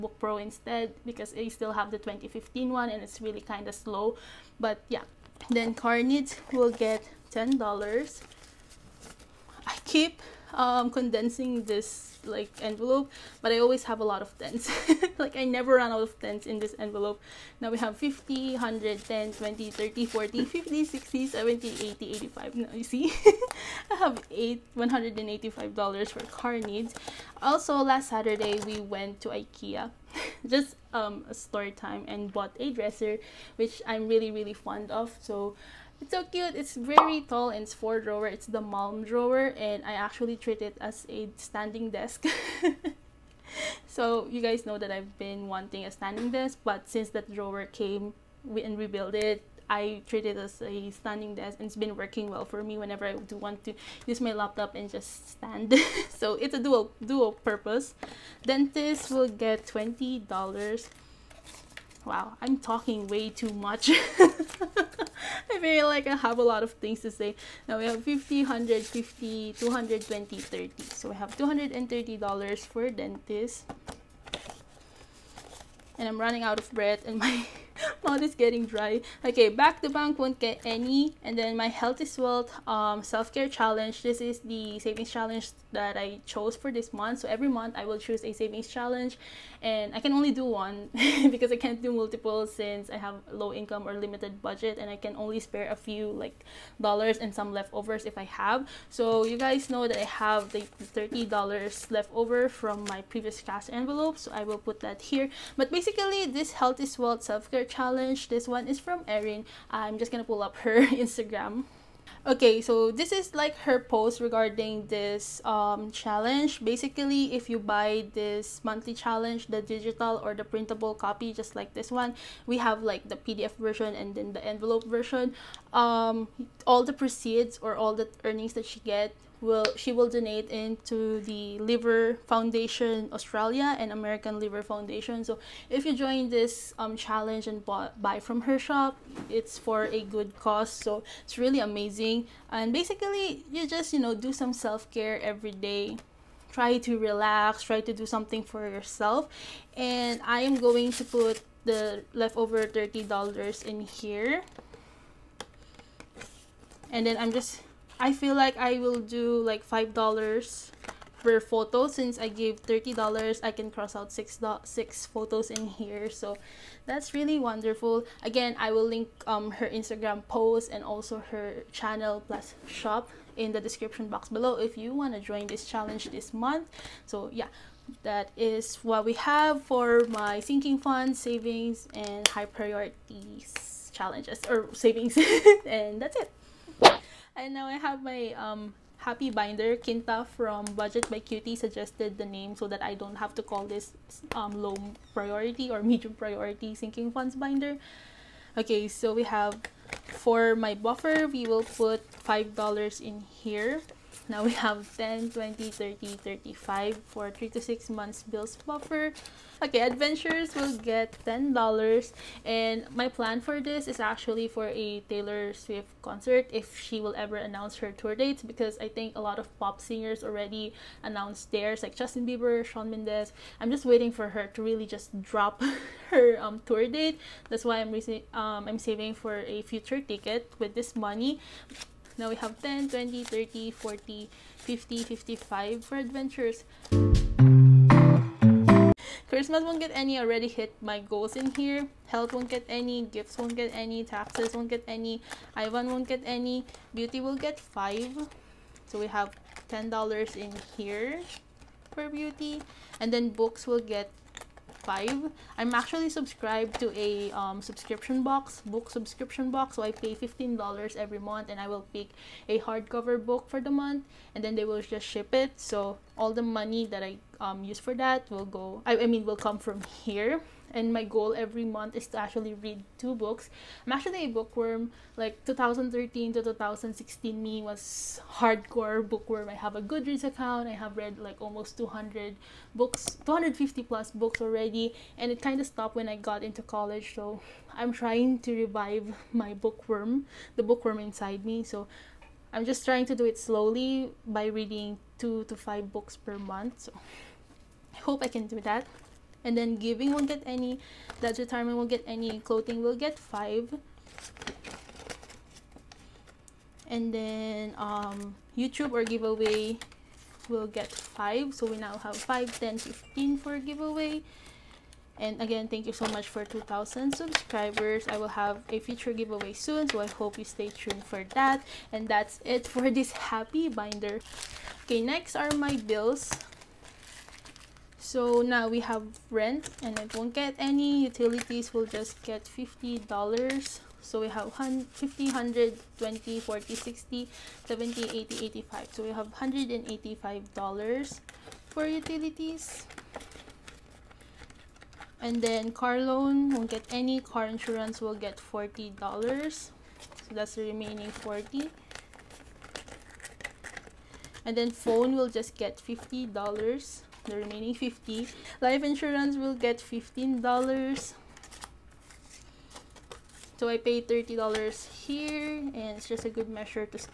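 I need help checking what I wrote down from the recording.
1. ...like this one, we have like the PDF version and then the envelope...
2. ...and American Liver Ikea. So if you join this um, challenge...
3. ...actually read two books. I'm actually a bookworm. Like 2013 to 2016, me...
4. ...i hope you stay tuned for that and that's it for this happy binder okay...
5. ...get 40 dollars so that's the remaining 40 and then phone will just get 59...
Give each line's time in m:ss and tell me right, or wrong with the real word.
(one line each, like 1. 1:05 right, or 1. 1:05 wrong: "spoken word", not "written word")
1. 2:01 right
2. 2:13 wrong: "Foundation", not "Ikea"
3. 4:32 right
4. 5:19 right
5. 5:48 wrong: "50", not "59".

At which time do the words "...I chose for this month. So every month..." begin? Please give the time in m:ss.
1:25.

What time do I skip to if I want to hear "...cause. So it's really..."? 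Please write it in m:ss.
2:20.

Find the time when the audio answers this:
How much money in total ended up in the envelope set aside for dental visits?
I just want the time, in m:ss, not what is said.
1:11.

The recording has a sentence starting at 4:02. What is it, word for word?
Health won't get any, gifts won't get any, taxes won't get any, Ivan won't get any, beauty will get 5.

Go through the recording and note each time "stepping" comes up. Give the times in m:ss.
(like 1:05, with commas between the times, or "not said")
not said.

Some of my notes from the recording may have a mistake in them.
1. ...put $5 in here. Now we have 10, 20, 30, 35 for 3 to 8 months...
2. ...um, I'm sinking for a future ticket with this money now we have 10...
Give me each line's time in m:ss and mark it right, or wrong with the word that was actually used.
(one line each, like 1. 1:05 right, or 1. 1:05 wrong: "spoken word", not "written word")
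1. 3:21 wrong: "6", not "8"
2. 3:48 wrong: "saving", not "sinking".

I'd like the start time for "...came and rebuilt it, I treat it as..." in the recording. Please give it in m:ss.
0:47.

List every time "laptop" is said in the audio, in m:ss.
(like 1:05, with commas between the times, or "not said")
0:54.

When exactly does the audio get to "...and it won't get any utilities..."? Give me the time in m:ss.
5:29.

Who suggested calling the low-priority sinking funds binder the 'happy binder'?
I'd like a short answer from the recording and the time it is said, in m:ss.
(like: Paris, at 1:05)
Kinta, at 3:09.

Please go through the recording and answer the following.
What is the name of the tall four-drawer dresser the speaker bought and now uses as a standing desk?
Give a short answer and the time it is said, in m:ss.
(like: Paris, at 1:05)
Malm, at 0:38.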